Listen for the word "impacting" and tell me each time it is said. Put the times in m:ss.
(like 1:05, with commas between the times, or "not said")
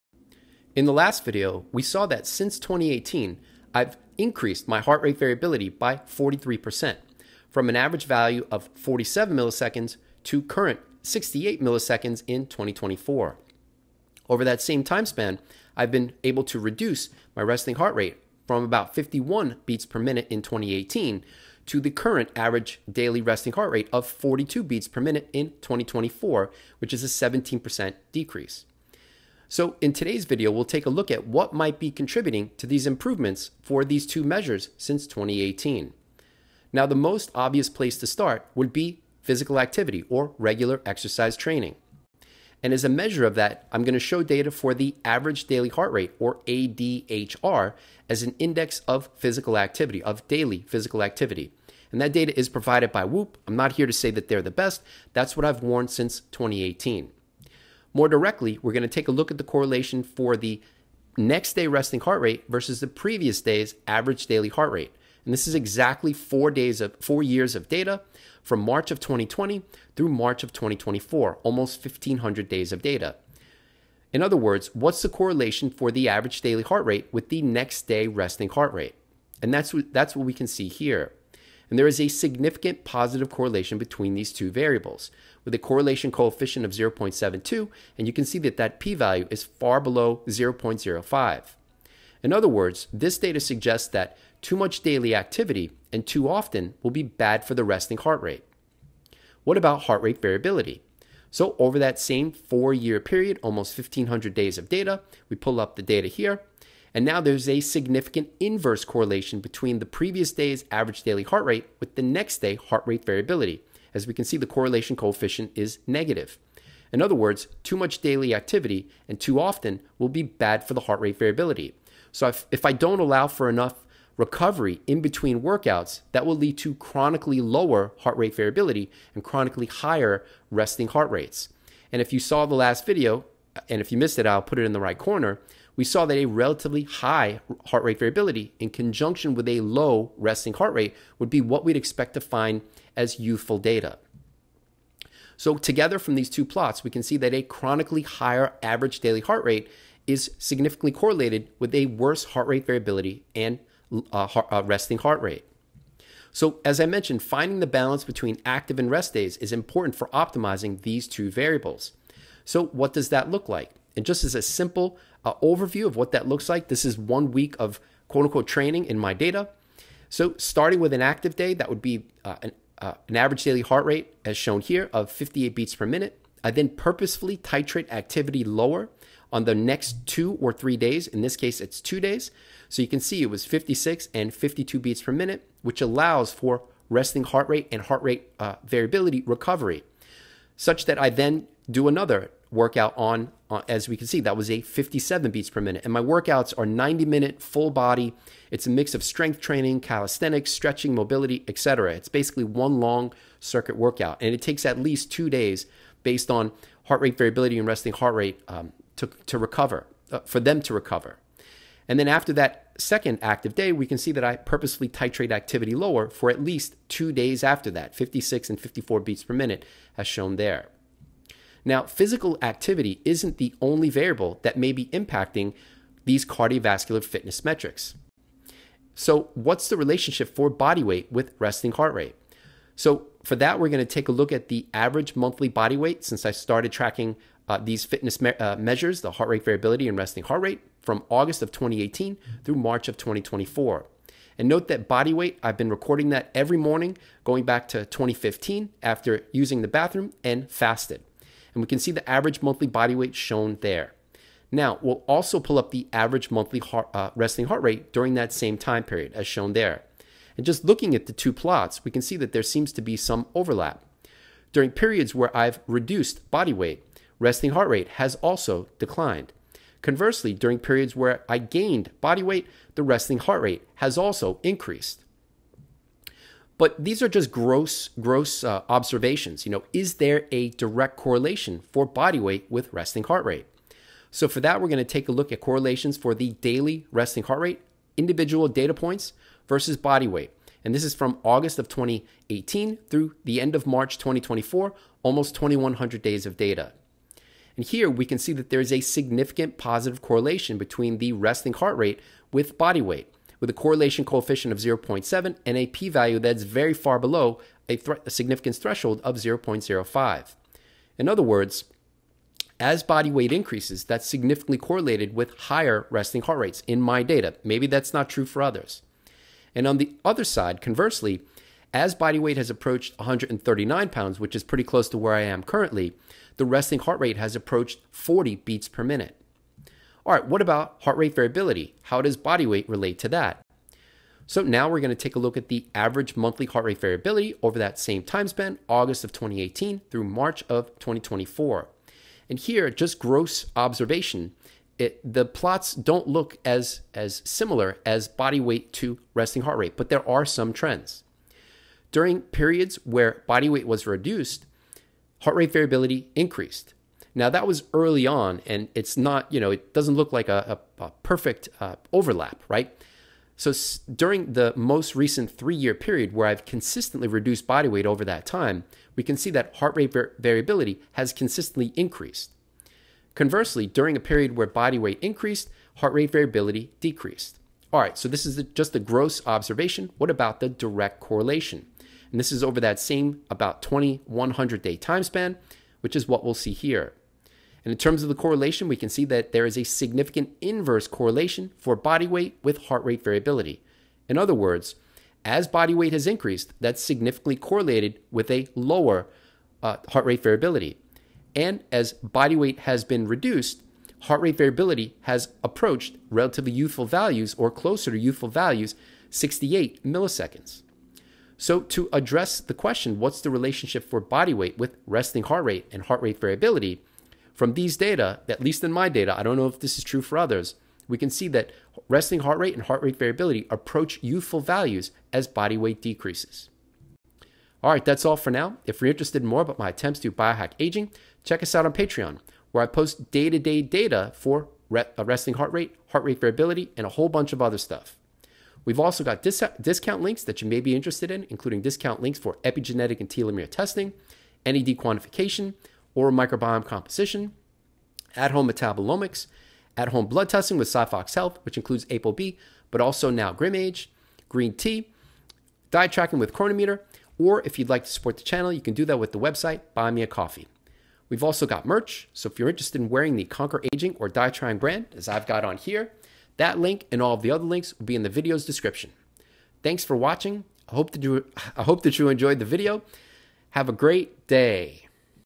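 3:44.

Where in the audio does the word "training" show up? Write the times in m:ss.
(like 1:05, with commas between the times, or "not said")
0:41, 2:48, 3:19.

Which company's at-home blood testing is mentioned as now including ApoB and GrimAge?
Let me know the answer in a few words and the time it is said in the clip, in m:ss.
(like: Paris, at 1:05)
SiPhox Health, at 7:30.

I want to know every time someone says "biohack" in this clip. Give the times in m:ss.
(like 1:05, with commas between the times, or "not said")
7:10.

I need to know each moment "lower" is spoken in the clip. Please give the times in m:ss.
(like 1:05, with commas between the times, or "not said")
2:07, 2:58, 3:35, 6:38.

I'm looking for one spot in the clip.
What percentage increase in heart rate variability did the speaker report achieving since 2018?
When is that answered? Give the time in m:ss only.
0:05.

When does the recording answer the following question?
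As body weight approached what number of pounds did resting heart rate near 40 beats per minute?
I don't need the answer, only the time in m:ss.
5:22.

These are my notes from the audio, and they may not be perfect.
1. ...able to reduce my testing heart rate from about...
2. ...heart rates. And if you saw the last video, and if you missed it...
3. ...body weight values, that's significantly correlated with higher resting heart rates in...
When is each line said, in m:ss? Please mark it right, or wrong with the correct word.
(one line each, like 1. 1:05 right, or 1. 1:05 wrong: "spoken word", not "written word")
1. 0:16 wrong: "resting", not "testing"
2. 2:10 right
3. 5:12 wrong: "increases", not "values".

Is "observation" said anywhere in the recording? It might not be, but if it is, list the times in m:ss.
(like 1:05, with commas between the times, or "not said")
4:38, 5:43, 6:19.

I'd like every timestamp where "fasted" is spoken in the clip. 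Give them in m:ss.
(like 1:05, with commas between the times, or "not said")
4:10.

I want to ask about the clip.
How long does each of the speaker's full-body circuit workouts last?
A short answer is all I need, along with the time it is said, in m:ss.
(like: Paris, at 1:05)
90 minutes, at 3:16.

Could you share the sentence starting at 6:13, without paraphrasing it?
Conversely, during a period where body weight increased, heart rate variability decreased.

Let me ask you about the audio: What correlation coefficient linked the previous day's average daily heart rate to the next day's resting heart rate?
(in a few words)
0.72.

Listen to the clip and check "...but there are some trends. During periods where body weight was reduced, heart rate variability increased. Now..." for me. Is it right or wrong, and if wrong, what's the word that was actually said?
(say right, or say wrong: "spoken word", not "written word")
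right.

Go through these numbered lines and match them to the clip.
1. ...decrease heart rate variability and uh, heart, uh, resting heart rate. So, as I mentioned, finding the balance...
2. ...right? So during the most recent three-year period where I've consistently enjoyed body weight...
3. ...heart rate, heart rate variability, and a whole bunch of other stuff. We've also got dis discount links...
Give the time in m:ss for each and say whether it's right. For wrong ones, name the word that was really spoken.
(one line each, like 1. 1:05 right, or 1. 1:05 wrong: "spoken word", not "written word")
1. 2:31 wrong: "worse", not "decrease"
2. 6:02 wrong: "reduced", not "enjoyed"
3. 7:15 right.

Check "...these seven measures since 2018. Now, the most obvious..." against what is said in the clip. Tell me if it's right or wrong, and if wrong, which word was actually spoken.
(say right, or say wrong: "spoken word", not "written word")
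wrong: "two", not "seven".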